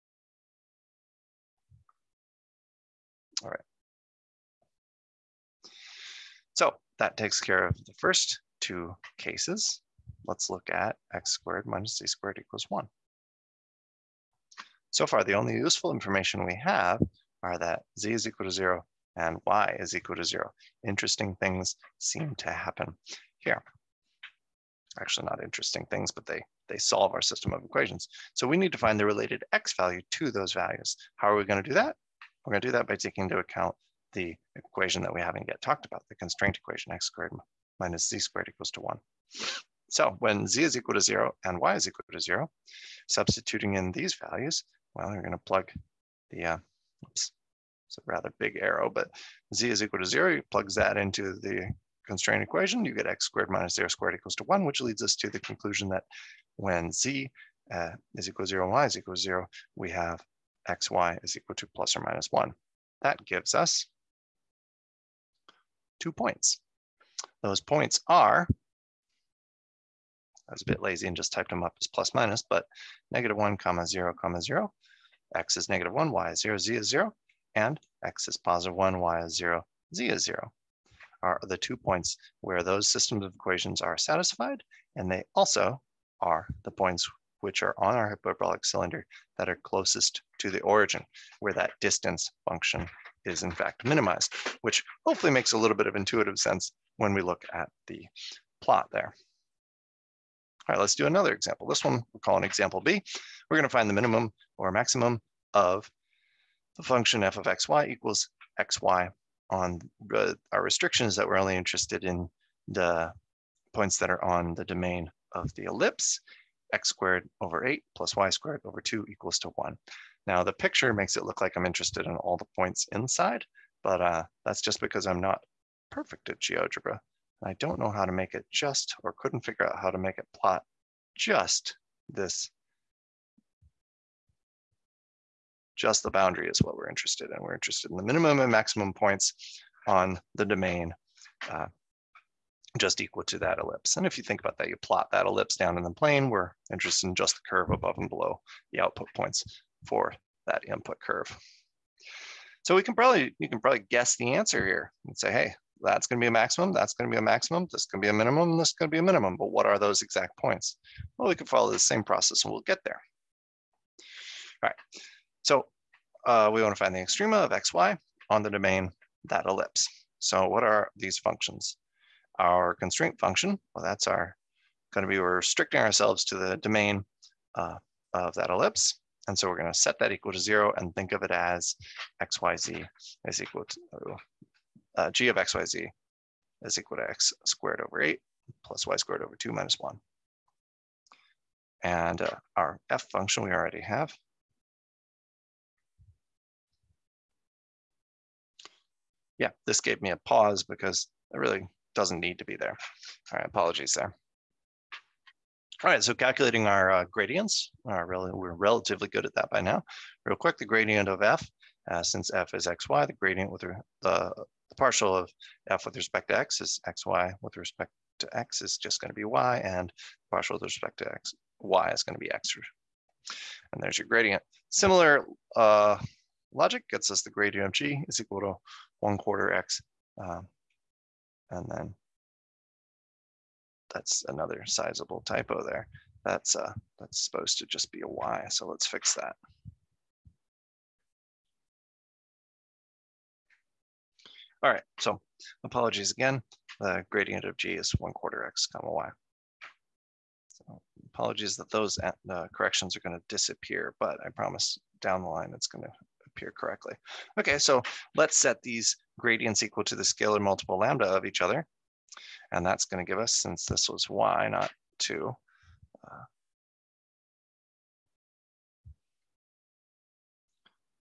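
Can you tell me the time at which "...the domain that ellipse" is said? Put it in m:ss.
2:48.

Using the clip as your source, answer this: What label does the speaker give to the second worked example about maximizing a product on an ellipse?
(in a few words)
example B.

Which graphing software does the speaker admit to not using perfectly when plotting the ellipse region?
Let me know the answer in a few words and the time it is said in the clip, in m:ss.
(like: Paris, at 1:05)
GeoGebra, at 2:06.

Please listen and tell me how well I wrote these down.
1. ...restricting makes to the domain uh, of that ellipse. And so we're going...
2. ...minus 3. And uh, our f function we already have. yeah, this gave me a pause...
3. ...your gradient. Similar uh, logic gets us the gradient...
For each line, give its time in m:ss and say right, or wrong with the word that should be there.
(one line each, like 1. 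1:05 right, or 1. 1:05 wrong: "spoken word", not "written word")
1. 2:55 wrong: "ourselves", not "makes"
2. 3:09 wrong: "1", not "3"
3. 3:43 right.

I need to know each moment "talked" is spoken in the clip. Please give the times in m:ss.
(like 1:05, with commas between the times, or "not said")
0:35.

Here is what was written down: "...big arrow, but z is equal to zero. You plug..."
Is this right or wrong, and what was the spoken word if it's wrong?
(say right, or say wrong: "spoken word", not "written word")
right.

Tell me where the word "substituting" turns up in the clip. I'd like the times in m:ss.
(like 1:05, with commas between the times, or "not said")
0:43.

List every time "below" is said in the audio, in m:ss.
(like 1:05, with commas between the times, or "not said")
2:28.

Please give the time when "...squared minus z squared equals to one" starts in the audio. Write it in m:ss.
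0:37.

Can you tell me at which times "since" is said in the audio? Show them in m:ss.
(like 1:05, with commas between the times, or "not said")
3:32, 4:23.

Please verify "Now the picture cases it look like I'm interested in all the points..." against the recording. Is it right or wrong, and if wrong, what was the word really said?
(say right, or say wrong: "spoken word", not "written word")
wrong: "makes", not "cases".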